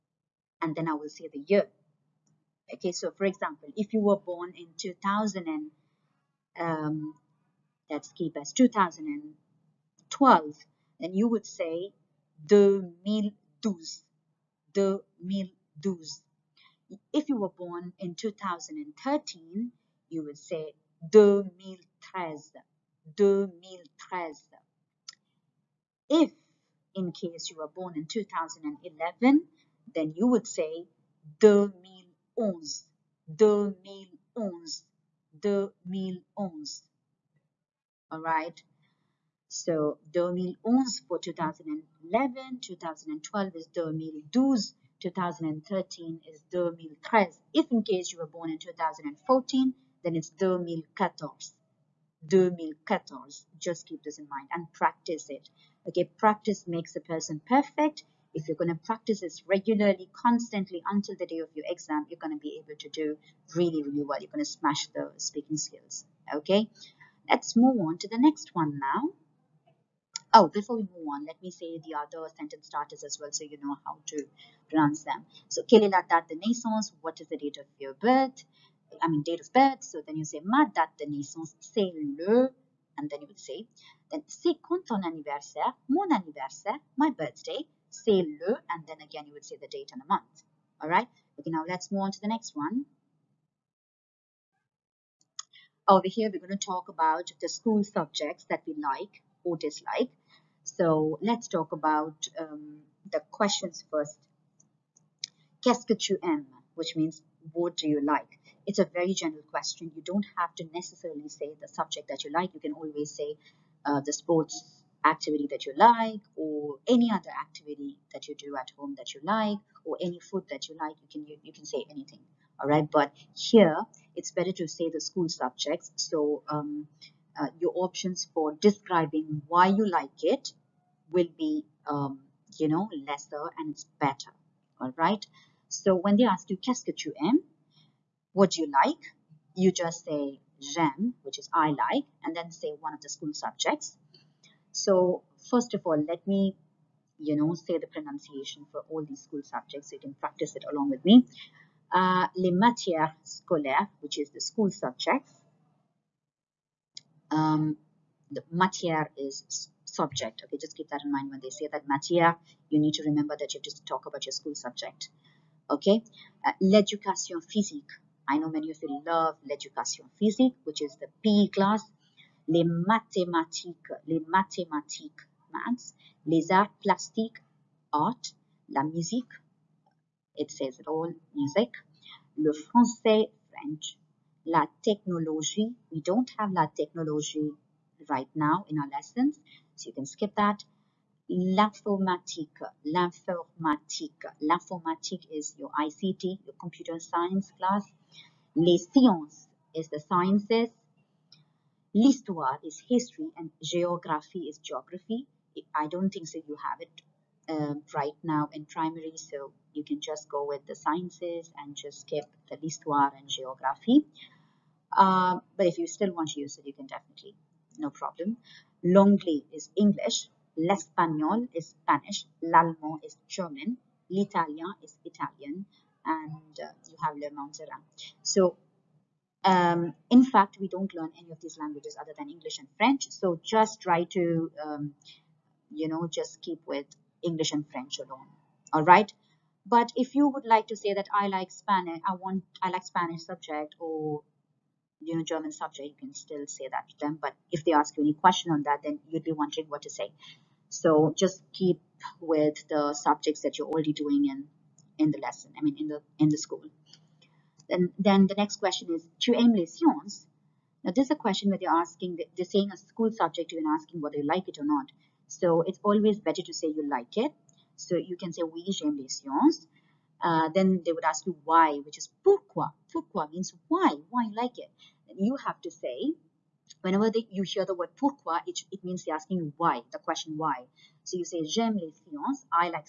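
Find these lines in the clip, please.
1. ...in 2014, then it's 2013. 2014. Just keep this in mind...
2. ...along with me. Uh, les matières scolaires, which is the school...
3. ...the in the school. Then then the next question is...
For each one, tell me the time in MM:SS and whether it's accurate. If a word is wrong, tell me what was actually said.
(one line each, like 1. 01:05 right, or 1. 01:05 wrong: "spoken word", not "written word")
1. 00:48 wrong: "2014", not "2013"
2. 02:30 right
3. 04:15 right.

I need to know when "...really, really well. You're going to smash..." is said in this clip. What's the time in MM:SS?
01:03.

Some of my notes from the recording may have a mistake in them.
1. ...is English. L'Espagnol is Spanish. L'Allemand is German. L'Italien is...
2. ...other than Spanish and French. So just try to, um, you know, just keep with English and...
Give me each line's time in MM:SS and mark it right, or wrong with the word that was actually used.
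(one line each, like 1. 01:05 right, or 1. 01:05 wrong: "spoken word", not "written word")
1. 03:39 right
2. 03:52 wrong: "English", not "Spanish".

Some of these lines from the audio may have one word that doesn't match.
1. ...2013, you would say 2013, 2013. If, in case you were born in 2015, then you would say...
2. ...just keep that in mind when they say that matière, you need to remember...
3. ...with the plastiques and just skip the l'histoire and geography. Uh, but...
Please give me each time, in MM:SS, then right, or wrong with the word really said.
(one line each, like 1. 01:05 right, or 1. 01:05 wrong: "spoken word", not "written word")
1. 00:18 wrong: "2011", not "2015"
2. 02:40 right
3. 03:30 wrong: "sciences", not "plastiques".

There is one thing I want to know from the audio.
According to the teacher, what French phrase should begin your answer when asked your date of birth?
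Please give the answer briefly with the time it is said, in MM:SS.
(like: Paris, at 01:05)
ma date de naissance c'est le, at 01:20.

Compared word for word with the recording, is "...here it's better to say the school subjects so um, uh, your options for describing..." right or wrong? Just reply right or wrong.
right.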